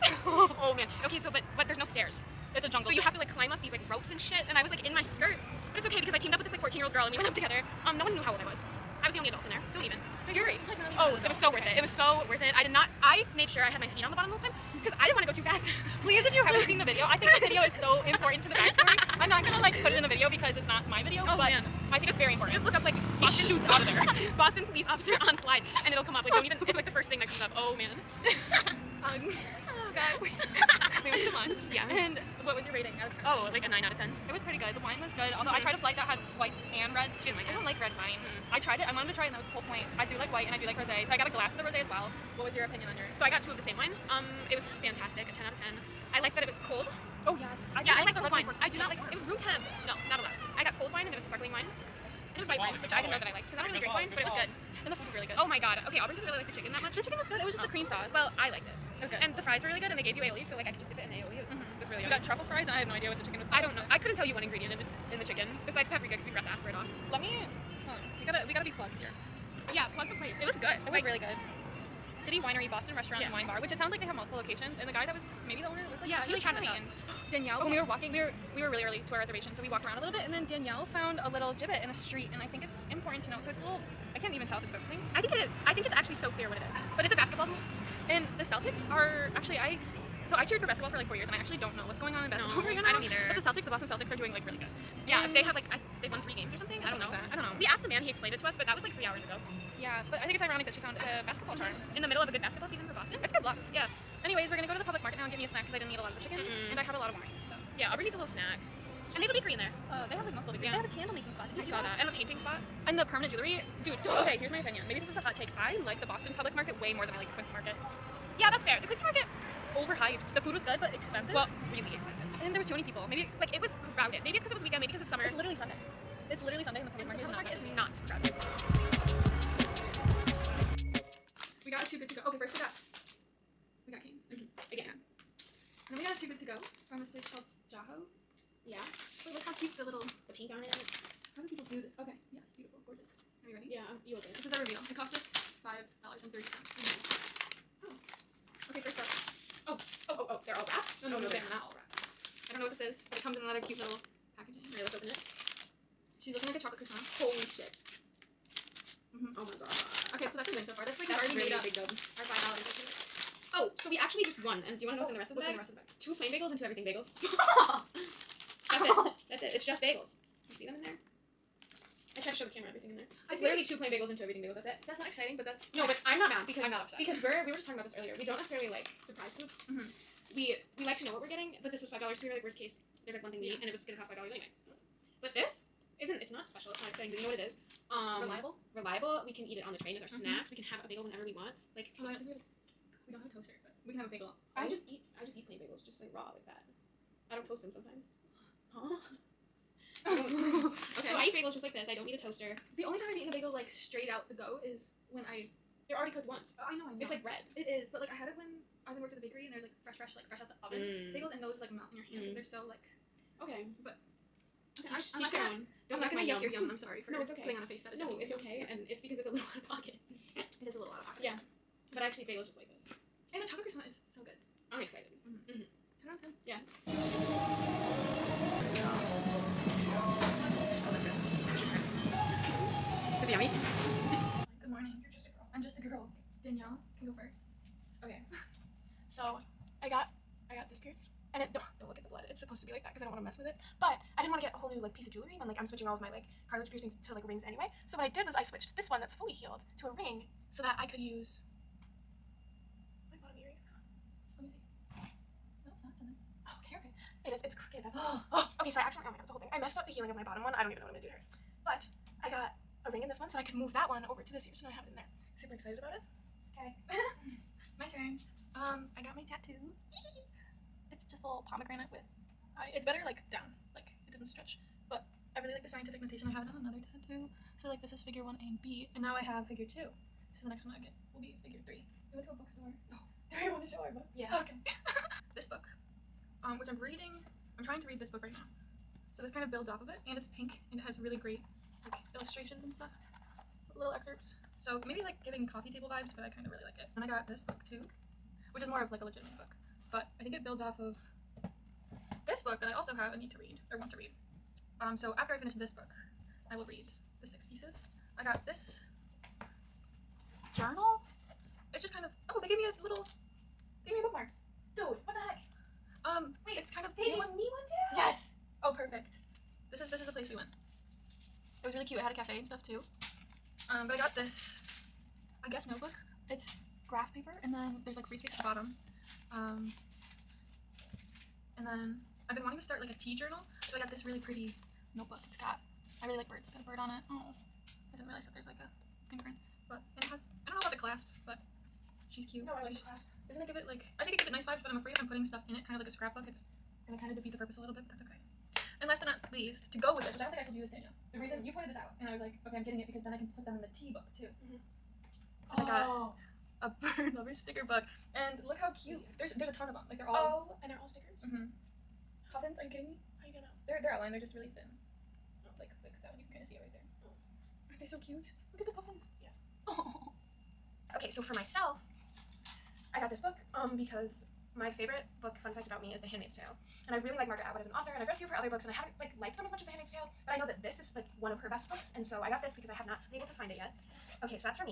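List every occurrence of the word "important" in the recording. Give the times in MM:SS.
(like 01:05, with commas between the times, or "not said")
00:18, 00:22, 01:22.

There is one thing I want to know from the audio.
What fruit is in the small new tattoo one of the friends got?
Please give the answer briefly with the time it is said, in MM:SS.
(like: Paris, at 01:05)
pomegranate, at 04:31.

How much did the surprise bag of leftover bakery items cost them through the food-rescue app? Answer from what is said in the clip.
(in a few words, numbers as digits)
$5.30.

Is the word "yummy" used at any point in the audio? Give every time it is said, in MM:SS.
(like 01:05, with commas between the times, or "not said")
01:02, 03:53.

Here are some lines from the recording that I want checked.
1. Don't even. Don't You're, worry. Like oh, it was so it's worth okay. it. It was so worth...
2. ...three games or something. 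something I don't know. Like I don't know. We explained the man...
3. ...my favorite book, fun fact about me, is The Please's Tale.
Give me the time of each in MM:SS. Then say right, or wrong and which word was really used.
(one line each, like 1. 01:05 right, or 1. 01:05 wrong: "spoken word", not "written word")
1. 00:09 right
2. 01:36 wrong: "asked", not "explained"
3. 06:14 wrong: "Handmaid", not "Please".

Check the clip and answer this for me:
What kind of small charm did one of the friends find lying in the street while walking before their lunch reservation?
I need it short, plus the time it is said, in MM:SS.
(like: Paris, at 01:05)
basketball hoop, at 01:27.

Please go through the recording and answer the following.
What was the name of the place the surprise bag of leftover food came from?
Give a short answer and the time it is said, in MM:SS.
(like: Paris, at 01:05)
Jaho, at 02:17.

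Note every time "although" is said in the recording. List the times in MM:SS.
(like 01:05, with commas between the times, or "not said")
00:35, 03:12.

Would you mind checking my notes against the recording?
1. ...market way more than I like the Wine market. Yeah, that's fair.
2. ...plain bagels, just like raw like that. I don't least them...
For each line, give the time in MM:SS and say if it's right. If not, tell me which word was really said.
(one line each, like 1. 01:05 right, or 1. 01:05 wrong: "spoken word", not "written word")
1. 01:56 wrong: "Quincy", not "Wine"
2. 03:15 wrong: "toast", not "least".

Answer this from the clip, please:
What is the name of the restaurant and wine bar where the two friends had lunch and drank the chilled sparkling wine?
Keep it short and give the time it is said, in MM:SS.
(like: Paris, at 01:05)
City Winery, at 01:12.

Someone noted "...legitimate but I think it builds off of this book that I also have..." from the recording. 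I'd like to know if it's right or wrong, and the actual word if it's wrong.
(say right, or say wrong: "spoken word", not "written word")
right.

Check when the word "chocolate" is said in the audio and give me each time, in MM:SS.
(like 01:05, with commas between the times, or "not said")
02:36, 03:43.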